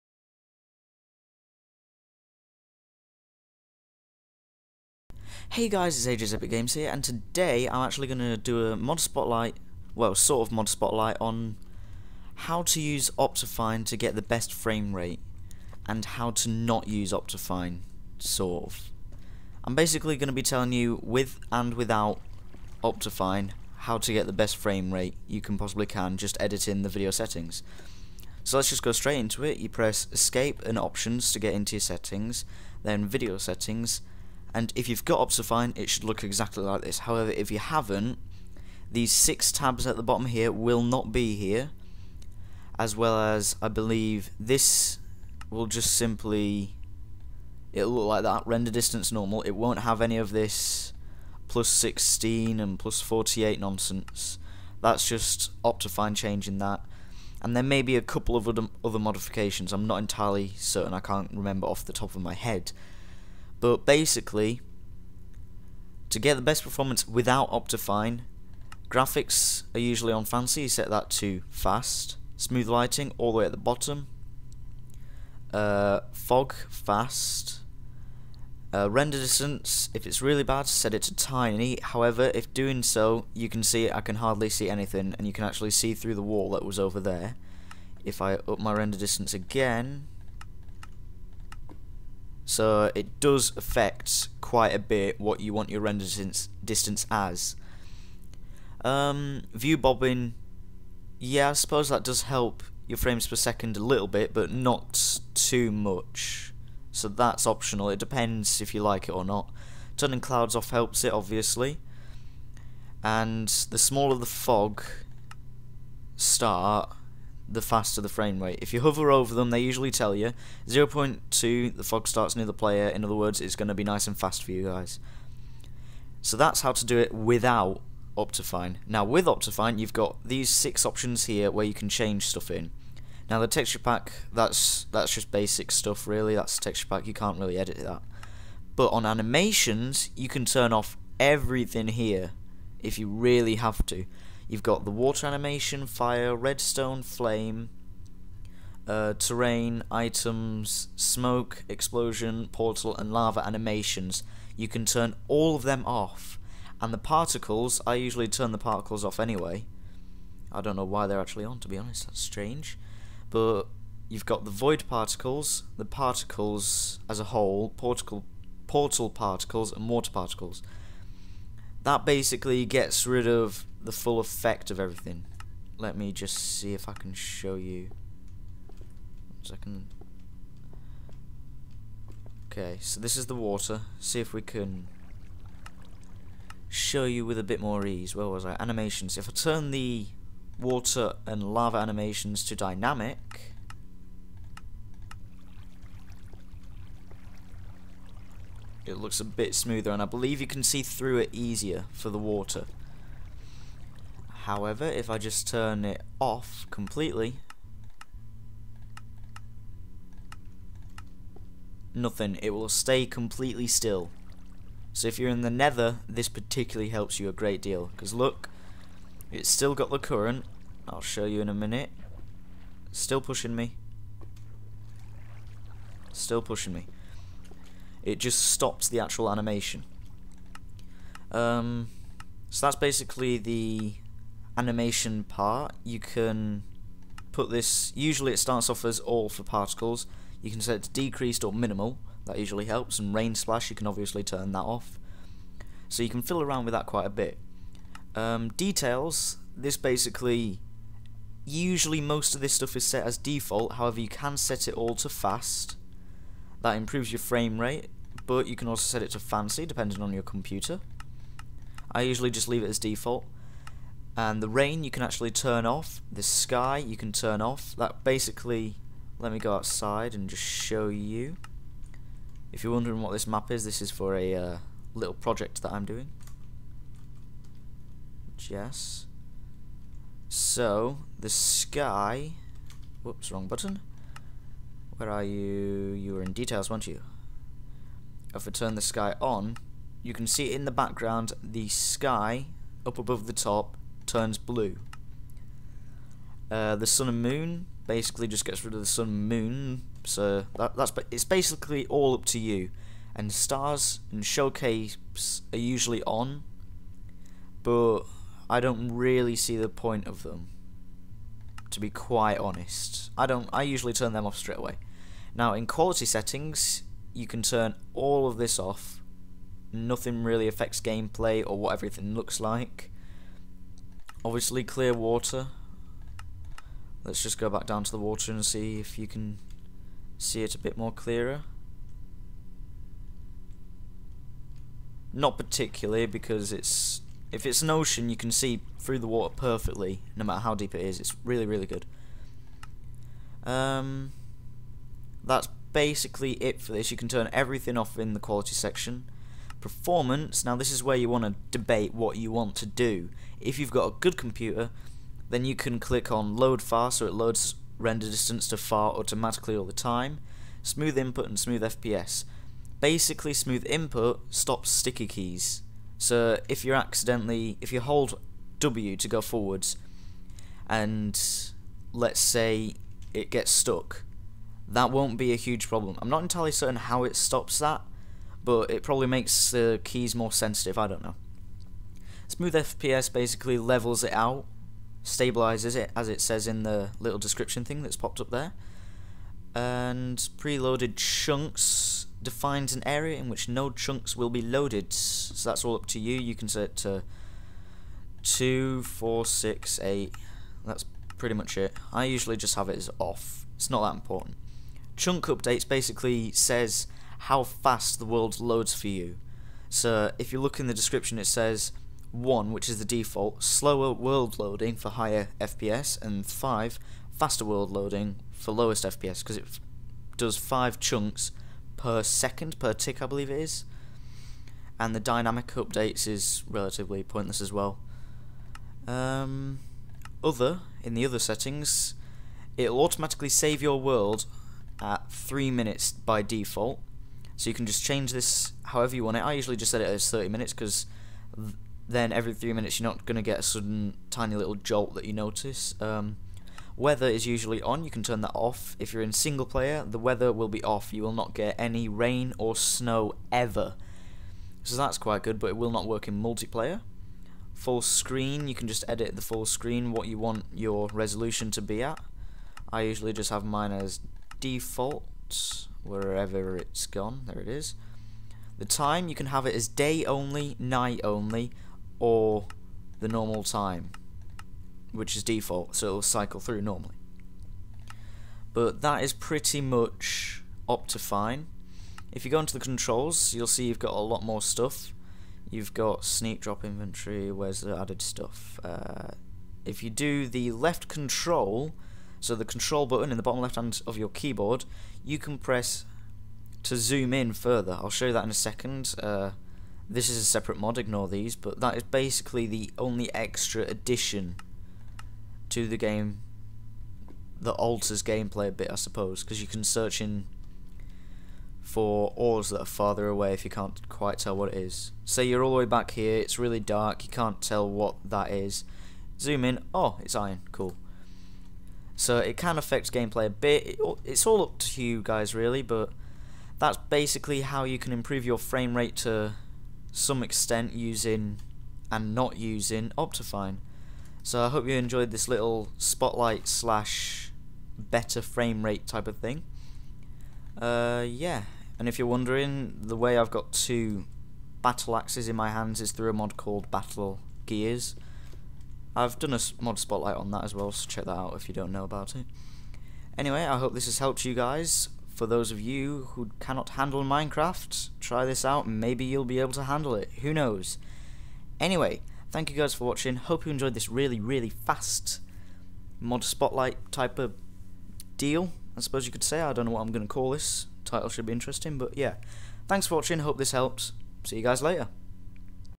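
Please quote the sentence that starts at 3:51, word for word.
Um, so that's basically the animation part.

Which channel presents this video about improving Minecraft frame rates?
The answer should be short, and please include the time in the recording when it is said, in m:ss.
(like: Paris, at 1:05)
AJ's Epic Games, at 0:06.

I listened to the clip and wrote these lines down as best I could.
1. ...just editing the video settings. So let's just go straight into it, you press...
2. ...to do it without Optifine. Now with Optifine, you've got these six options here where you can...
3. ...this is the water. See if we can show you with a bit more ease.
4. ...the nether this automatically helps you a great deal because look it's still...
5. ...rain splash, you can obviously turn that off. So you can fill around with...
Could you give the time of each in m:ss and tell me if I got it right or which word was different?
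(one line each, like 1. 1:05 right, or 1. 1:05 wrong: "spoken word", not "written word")
1. 0:26 right
2. 2:06 right
3. 3:02 right
4. 3:35 wrong: "particularly", not "automatically"
5. 4:03 right.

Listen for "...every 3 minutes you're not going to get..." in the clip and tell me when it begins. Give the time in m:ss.
7:22.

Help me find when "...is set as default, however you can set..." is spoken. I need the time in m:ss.
4:12.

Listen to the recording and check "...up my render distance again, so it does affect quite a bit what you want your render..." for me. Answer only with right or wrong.
right.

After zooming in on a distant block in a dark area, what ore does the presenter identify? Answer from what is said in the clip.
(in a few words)
iron.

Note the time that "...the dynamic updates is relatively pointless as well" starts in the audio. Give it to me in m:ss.
7:04.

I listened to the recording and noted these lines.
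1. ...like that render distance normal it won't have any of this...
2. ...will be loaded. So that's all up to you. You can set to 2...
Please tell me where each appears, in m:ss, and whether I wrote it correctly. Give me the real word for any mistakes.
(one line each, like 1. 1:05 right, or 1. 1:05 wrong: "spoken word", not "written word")
1. 0:48 right
2. 6:34 right.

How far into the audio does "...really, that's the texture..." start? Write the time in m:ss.
2:16.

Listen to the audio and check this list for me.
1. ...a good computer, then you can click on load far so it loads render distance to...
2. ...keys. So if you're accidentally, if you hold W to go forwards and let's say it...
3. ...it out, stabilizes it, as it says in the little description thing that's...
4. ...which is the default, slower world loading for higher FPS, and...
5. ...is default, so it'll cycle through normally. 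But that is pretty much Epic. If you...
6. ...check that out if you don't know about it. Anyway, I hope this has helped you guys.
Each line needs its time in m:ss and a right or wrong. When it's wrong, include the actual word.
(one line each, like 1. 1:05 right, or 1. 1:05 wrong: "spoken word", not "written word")
1. 5:53 right
2. 6:05 right
3. 6:24 right
4. 6:52 right
5. 7:55 wrong: "Optifine", not "Epic"
6. 9:10 right.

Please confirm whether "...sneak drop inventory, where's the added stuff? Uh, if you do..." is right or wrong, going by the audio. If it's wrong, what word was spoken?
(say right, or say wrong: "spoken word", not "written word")
right.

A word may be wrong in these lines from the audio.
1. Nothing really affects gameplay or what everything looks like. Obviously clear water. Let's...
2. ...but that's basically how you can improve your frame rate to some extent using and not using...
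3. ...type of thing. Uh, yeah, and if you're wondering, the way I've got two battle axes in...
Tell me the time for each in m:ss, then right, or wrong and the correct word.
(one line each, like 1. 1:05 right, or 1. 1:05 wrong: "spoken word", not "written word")
1. 5:19 right
2. 8:45 right
3. 8:58 right.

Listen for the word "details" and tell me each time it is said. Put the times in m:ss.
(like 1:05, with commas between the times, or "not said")
4:08, 4:46.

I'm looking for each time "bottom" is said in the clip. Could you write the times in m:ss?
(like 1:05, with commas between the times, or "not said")
0:40, 1:13, 8:13.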